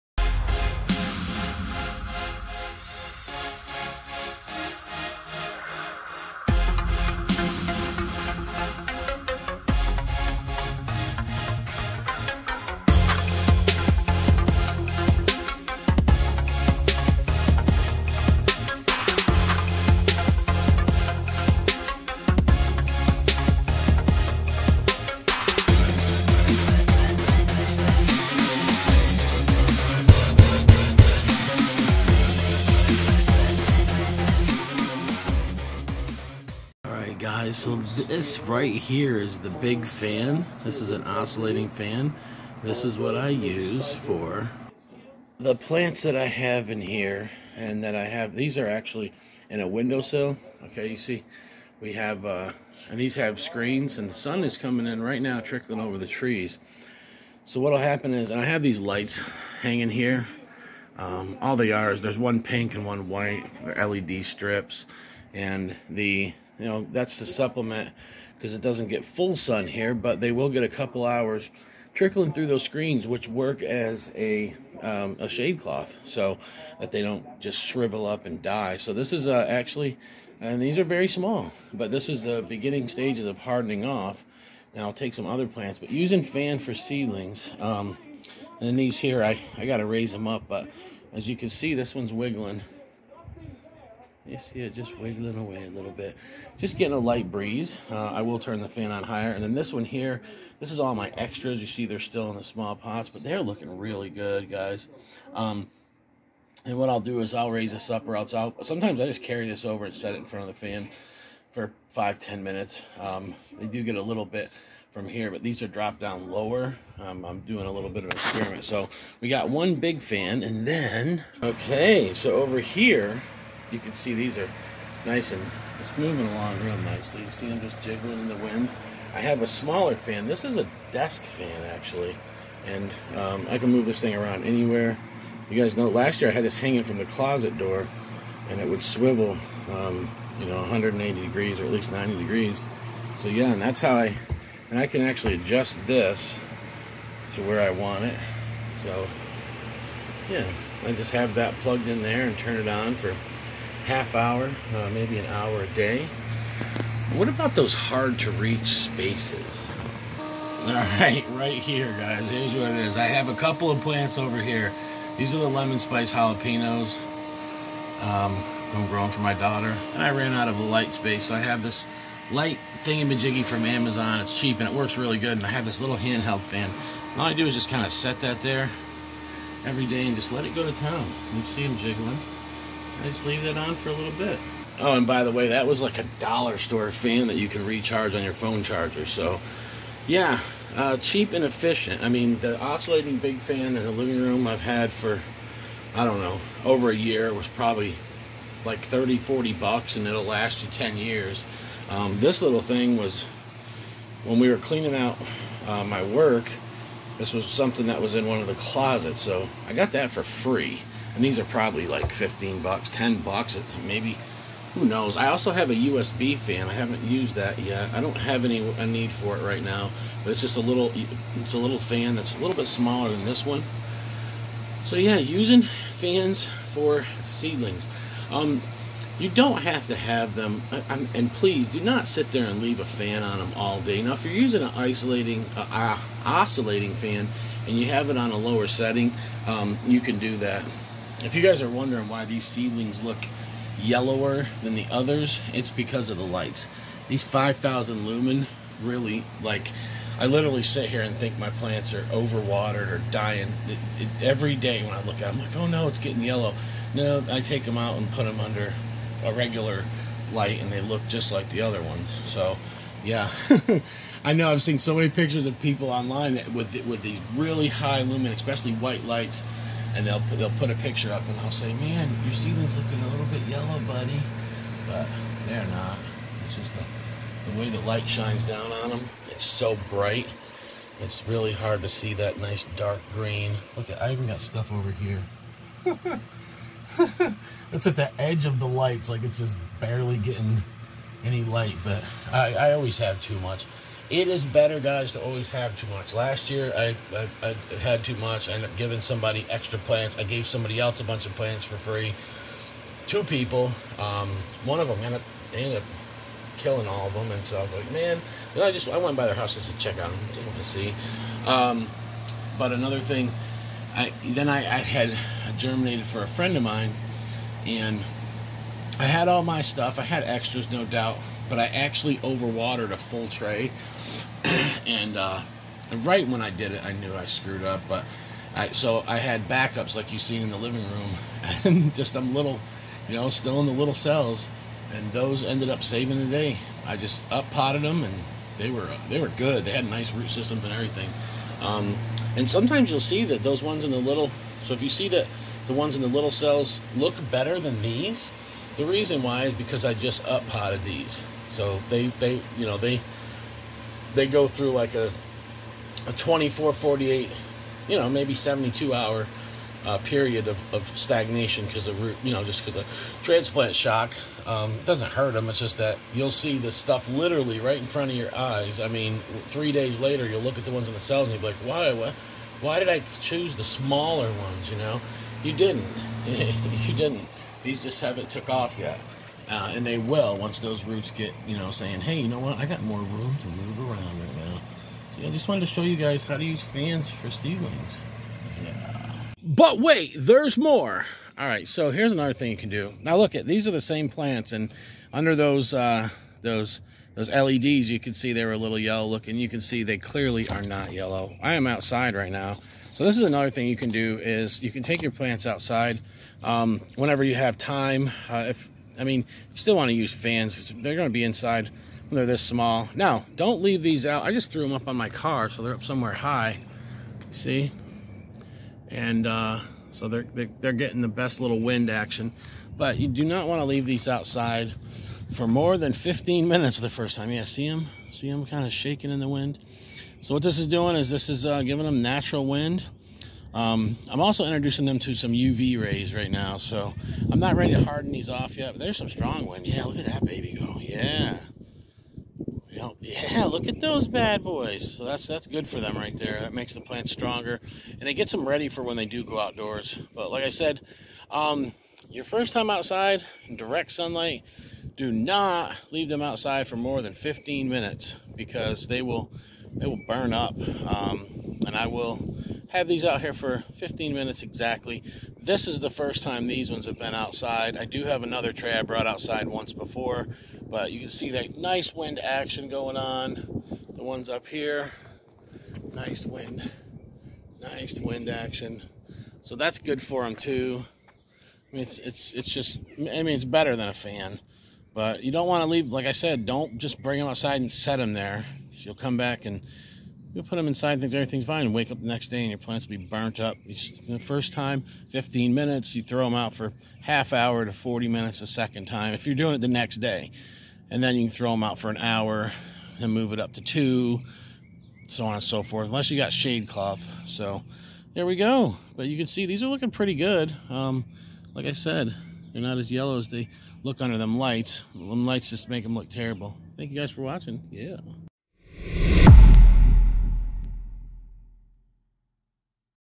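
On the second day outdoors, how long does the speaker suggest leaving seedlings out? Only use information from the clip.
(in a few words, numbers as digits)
half hour to 40 minutes.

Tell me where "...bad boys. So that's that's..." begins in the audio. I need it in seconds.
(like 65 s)
444 s.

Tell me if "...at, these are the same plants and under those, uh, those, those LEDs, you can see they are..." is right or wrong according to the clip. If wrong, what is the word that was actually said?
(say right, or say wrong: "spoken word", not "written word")
right.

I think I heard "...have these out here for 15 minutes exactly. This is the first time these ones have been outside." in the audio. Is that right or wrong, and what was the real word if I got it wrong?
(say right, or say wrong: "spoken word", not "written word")
right.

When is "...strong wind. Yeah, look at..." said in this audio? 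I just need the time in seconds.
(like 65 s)
439 s.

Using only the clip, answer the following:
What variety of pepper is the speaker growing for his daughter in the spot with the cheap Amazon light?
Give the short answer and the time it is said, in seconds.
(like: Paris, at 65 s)
lemon spice jalapenos, at 165 s.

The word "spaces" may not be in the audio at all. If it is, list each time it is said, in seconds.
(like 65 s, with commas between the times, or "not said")
158 s, 170 s.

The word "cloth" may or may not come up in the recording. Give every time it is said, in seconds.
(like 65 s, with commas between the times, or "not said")
75 s, 506 s.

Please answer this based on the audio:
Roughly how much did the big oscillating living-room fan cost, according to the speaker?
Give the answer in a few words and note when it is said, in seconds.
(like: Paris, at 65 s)
30-40 dollars, at 198 s.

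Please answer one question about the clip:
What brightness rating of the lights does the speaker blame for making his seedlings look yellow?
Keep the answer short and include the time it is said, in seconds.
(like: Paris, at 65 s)
5,000 lumen, at 247 s.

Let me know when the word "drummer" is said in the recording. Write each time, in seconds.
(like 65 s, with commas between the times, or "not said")
not said.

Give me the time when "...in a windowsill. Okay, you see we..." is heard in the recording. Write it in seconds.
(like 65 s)
49 s.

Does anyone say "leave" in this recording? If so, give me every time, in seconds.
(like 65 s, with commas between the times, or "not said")
183 s, 232 s, 413 s, 423 s, 455 s, 485 s.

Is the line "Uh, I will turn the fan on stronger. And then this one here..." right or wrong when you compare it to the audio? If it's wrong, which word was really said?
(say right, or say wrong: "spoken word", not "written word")
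wrong: "higher", not "stronger".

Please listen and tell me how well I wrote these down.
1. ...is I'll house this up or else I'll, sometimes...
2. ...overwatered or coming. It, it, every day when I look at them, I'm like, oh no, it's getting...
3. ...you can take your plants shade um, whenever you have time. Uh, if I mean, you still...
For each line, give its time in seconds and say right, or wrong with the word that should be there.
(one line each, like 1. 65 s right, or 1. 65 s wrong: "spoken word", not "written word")
1. 107 s wrong: "raise", not "house"
2. 252 s wrong: "dying", not "coming"
3. 404 s wrong: "outside", not "shade".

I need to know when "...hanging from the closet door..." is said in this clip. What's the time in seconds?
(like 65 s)
136 s.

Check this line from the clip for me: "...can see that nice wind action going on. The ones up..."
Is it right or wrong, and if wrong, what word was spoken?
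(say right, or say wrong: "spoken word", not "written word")
right.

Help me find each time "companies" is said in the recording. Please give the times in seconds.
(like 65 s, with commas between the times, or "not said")
not said.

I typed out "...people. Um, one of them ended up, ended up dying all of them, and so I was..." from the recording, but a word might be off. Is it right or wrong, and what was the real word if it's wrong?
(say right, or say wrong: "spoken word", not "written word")
wrong: "killing", not "dying".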